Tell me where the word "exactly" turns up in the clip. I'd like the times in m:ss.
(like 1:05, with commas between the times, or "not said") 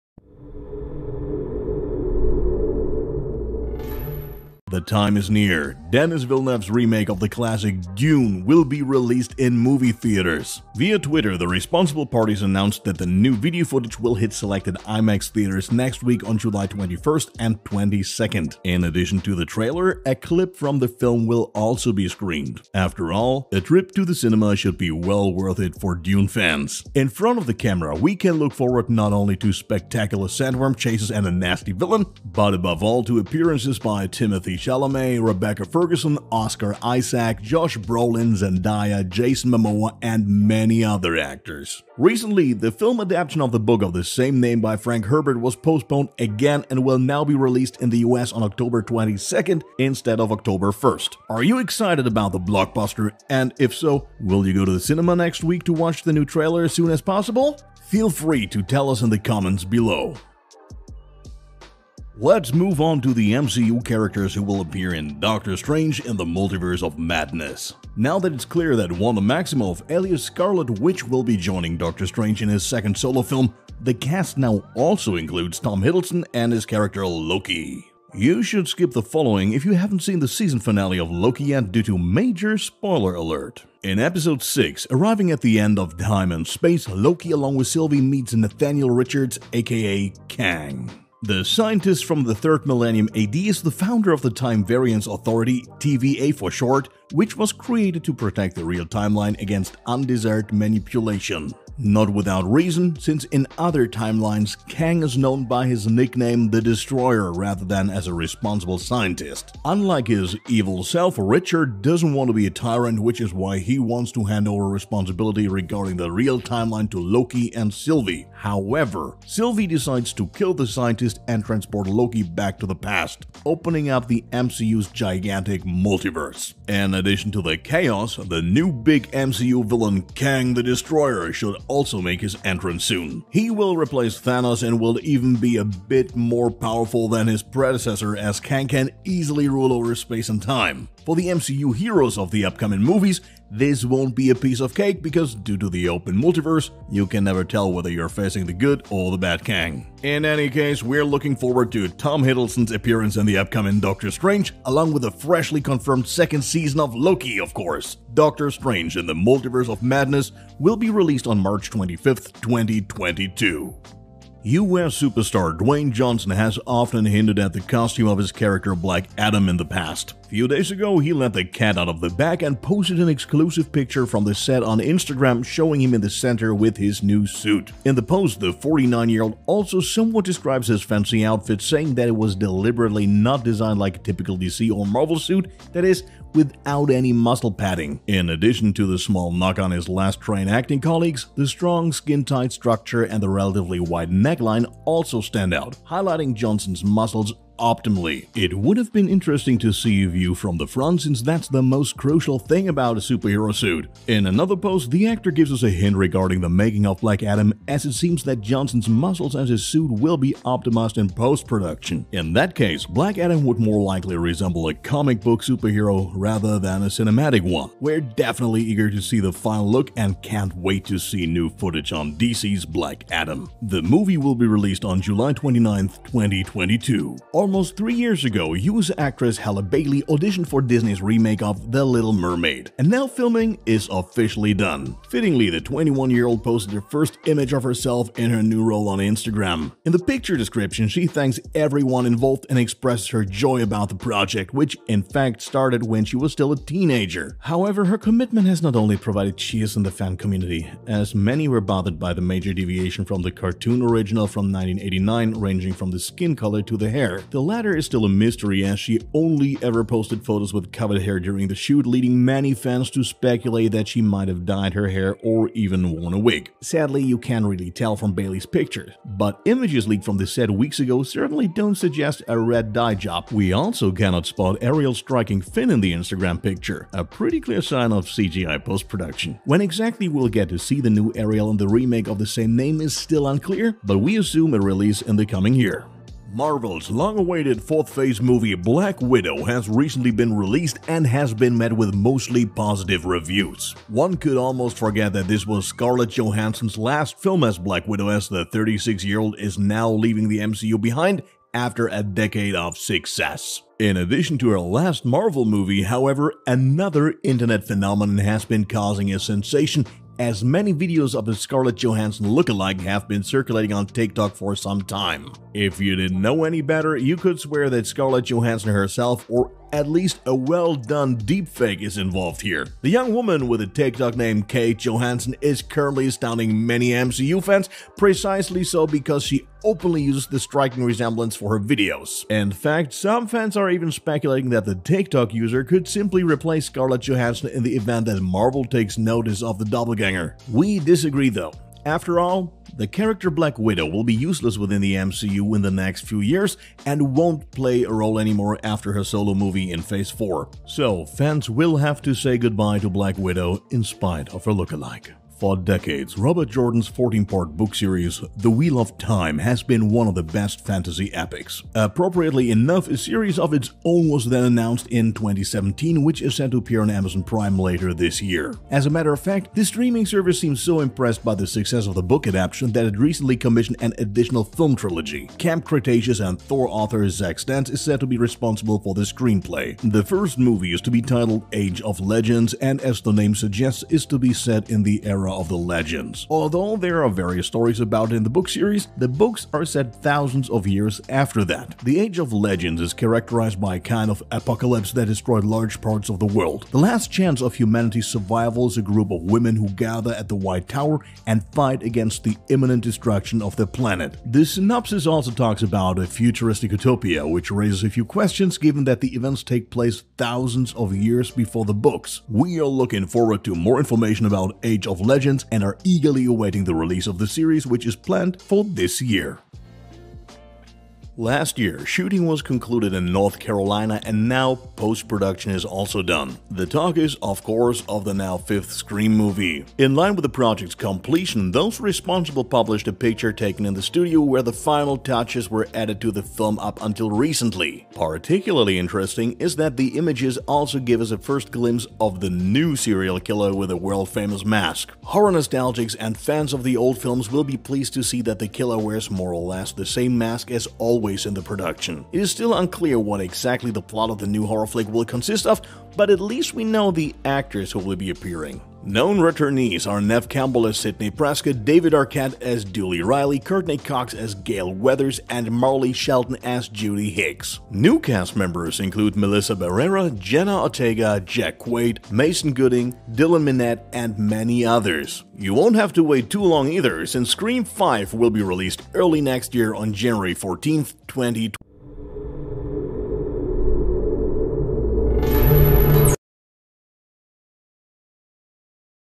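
4:39, 7:33.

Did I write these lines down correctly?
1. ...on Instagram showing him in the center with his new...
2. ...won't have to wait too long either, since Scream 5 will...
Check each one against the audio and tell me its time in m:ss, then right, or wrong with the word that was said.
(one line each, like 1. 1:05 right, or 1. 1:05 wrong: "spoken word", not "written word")
1. 2:54 right
2. 7:55 right.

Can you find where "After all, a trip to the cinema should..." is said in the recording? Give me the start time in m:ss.
0:22.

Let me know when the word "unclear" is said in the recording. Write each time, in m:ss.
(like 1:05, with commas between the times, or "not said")
4:43, 7:32.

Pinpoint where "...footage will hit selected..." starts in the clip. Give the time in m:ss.
0:13.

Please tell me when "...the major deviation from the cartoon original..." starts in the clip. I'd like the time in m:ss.
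4:12.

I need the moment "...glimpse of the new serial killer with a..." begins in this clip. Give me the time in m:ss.
7:21.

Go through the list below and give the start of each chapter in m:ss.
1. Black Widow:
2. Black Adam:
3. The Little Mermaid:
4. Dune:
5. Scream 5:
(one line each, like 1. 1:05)
1. 1:43
2. 2:52
3. 4:54
4. 3:56
5. 5:53.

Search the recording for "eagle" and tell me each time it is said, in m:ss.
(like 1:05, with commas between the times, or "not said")
not said.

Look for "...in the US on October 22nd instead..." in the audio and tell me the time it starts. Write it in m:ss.
0:47.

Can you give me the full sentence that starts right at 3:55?
Fittingly, the 21-year-old posted her first image of herself in her new role on Instagram.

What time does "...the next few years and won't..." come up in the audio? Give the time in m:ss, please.
5:45.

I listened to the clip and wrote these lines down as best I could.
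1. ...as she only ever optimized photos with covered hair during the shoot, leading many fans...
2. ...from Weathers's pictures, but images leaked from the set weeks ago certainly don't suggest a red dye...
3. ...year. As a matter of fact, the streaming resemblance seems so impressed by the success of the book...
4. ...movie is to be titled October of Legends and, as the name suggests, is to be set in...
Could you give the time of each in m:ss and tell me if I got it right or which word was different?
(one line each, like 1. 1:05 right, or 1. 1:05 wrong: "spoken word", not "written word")
1. 4:18 wrong: "posted", not "optimized"
2. 4:27 wrong: "Bailey", not "Weathers"
3. 6:08 wrong: "service", not "resemblance"
4. 6:20 wrong: "Age", not "October".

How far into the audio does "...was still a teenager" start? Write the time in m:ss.
4:06.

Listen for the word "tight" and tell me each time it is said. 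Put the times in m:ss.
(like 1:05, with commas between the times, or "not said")
3:11.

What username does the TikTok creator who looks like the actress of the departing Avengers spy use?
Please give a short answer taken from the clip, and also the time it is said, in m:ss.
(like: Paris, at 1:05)
Kate Johansson, at 5:24.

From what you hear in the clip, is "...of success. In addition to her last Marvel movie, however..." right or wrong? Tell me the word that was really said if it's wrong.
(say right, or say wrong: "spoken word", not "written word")
right.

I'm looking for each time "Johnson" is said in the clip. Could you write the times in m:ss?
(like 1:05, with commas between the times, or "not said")
2:45, 3:16, 3:28.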